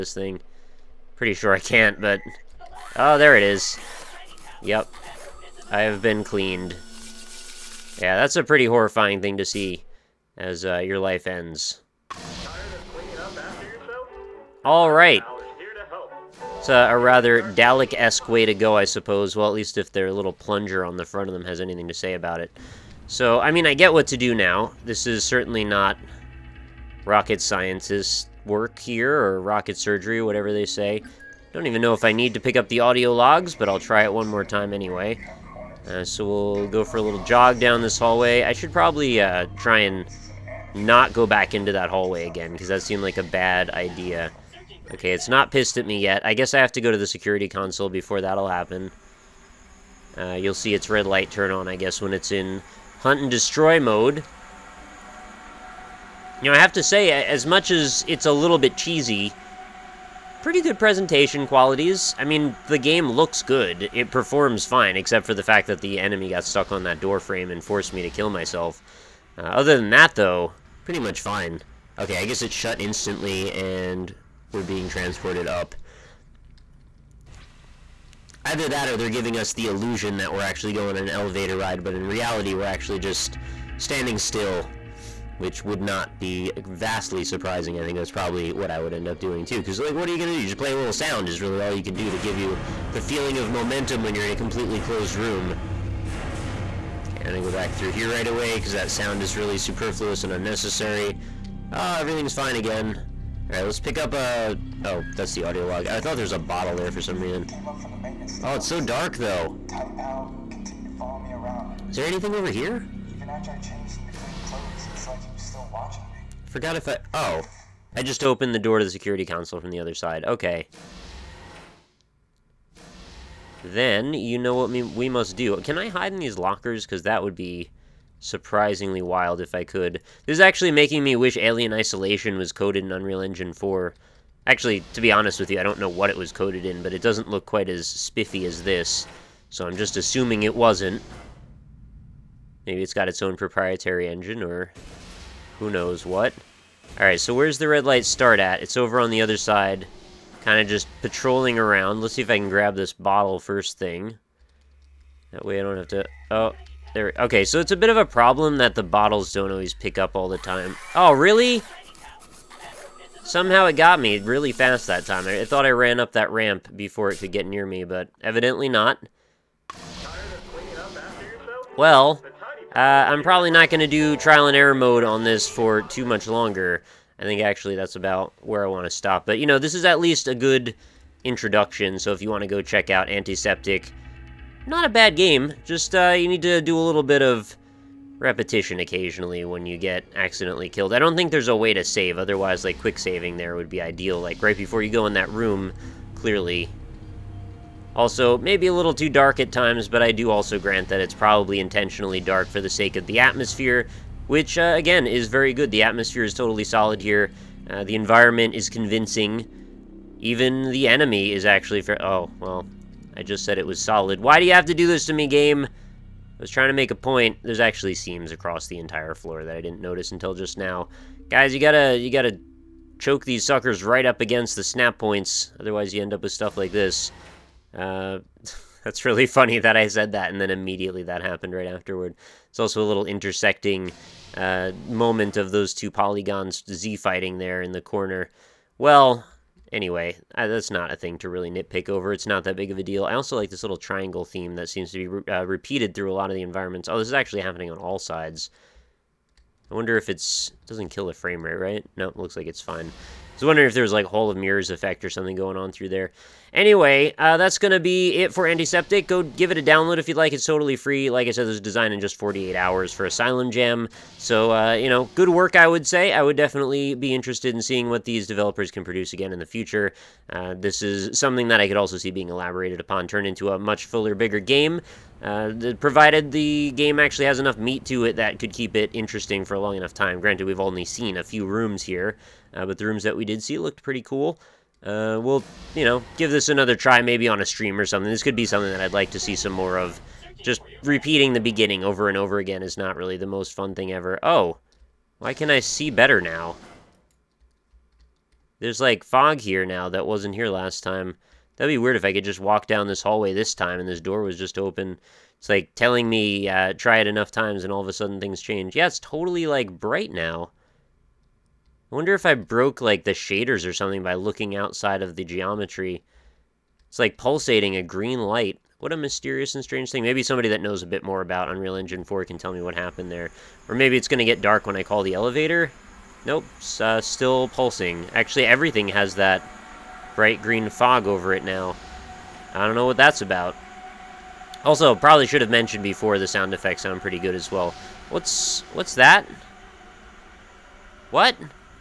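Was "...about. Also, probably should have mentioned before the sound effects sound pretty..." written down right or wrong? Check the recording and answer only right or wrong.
right.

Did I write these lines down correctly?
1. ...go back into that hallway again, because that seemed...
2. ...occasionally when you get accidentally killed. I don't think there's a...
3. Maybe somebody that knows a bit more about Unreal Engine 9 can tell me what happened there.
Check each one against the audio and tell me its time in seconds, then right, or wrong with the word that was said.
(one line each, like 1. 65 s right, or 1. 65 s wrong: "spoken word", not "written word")
1. 41 s right
2. 188 s right
3. 320 s wrong: "4", not "9".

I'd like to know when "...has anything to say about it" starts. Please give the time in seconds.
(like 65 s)
21 s.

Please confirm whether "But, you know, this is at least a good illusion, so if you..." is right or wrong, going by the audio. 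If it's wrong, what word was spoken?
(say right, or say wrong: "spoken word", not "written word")
wrong: "introduction", not "illusion".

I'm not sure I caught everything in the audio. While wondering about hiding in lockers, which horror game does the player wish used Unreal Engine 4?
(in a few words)
Alien Isolation.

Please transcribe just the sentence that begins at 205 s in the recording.
The atmosphere is totally solid here.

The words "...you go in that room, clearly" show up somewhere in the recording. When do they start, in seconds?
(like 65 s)
194 s.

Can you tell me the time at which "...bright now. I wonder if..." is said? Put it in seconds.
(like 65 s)
309 s.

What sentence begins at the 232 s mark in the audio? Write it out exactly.
It's also a little intersecting uh, moment of those two polygons Z-fighting there in the corner.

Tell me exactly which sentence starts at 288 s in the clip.
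This could be something that I'd like to see some more of.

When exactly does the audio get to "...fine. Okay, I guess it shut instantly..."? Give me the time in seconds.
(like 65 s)
71 s.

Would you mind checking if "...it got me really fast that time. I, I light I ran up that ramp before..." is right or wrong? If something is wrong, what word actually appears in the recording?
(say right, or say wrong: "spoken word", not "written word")
wrong: "thought", not "light".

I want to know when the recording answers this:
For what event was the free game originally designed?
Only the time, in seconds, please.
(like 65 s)
263 s.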